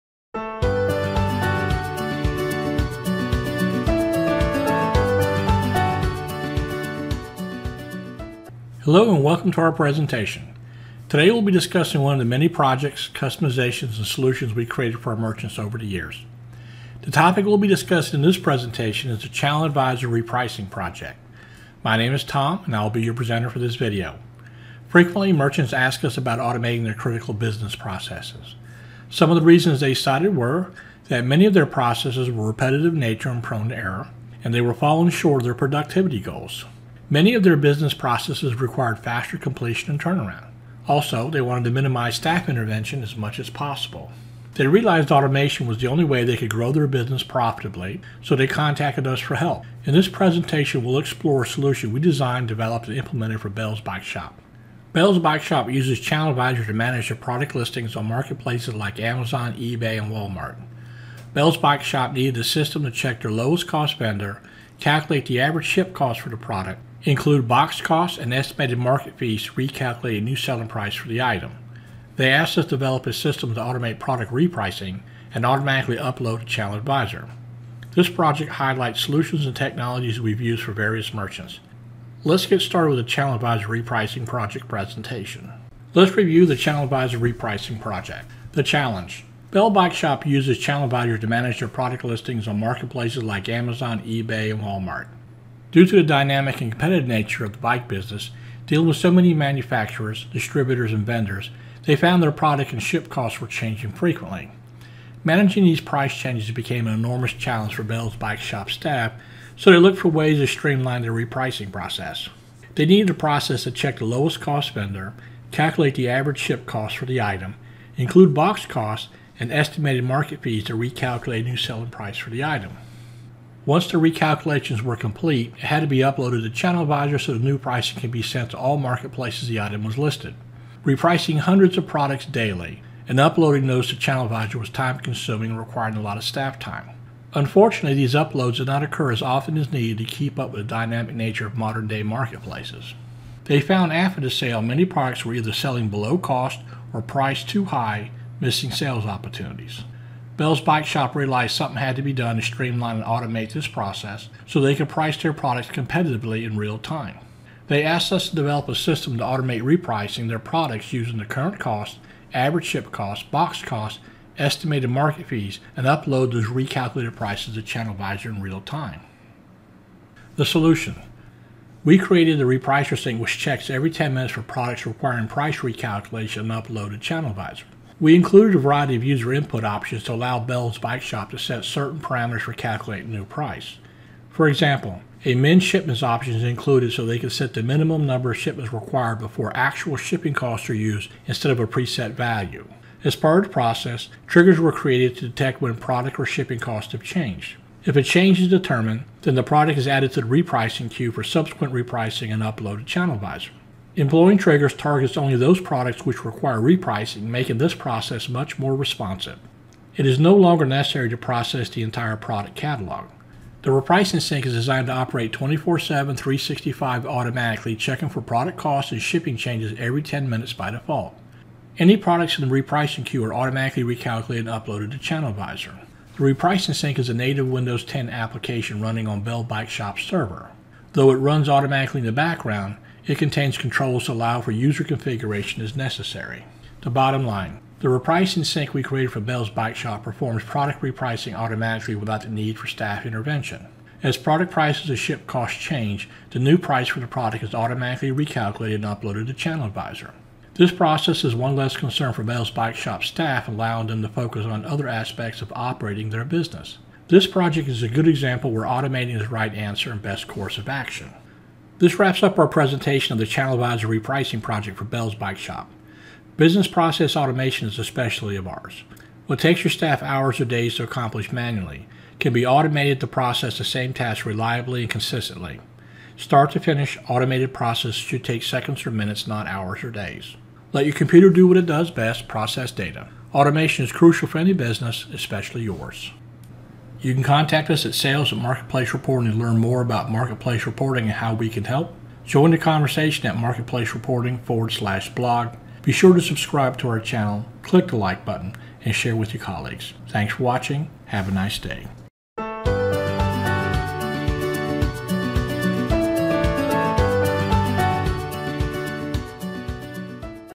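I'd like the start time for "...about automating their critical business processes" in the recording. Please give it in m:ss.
0:26.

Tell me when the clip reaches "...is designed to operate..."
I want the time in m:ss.
3:34.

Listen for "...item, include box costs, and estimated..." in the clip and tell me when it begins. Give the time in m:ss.
1:57.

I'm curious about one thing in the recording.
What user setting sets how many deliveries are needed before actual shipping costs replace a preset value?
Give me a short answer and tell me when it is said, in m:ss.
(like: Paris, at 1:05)
min shipments, at 3:05.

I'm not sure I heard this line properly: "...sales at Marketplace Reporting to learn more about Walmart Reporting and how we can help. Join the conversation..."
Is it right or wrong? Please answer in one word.
wrong.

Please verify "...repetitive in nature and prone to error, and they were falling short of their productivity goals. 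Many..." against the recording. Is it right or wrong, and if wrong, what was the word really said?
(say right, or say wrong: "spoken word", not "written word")
right.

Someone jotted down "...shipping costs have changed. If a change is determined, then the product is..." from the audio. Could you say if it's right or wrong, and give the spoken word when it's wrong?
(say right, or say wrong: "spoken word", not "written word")
right.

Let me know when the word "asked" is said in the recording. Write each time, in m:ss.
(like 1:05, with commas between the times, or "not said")
1:12, 2:37.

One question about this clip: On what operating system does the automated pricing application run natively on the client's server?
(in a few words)
Windows 10.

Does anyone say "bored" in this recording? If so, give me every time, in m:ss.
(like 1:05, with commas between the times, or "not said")
not said.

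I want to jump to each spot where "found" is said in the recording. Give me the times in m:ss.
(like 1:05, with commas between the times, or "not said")
1:41, 2:23.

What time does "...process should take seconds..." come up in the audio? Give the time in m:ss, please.
4:37.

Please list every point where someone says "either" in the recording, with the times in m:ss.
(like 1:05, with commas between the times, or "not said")
2:25.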